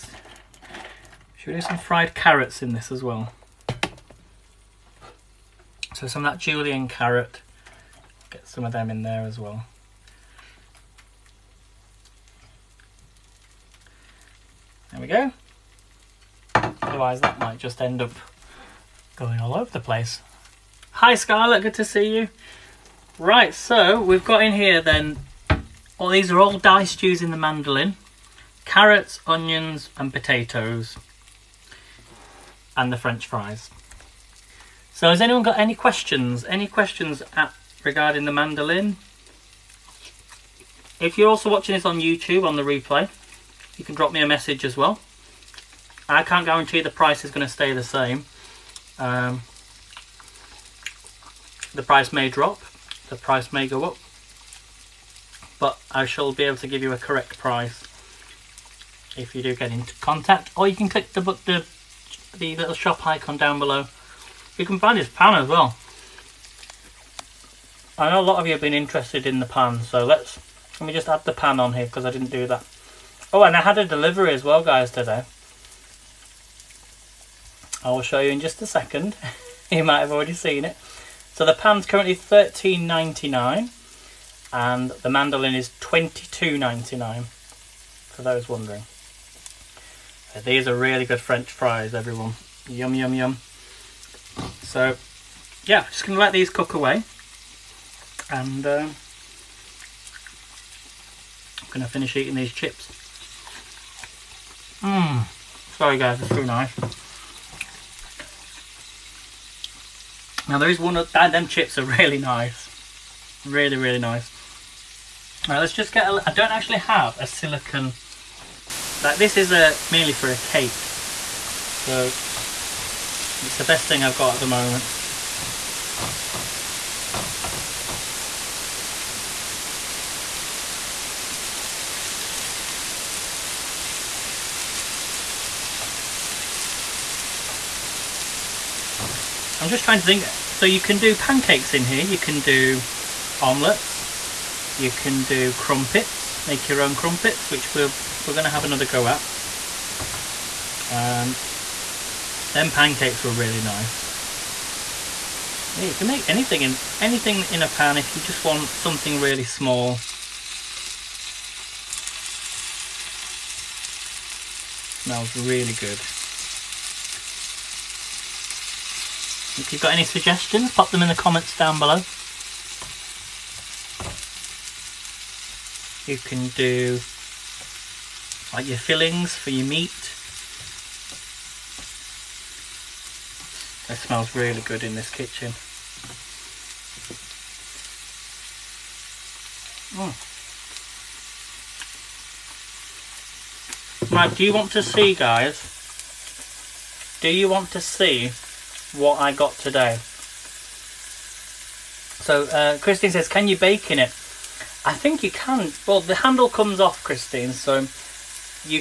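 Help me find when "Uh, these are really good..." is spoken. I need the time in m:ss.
1:30.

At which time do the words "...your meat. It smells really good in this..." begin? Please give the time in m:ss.
2:59.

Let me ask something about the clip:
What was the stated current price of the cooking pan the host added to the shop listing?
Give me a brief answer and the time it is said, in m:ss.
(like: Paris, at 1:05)
$13.99, at 1:22.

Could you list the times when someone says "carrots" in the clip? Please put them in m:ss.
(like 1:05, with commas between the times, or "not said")
0:02, 0:06, 0:28.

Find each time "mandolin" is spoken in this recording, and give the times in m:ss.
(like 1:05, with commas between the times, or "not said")
0:27, 0:38, 1:25.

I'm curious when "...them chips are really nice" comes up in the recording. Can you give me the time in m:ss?
1:51.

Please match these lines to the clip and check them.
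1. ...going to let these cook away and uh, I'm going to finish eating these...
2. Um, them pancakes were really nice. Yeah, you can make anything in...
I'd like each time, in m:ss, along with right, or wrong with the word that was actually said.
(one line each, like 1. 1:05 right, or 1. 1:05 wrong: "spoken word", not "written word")
1. 1:36 right
2. 2:30 right.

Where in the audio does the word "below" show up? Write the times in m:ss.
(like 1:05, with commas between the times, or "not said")
1:03, 2:51.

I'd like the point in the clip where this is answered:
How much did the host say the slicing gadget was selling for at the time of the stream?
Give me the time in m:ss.
1:25.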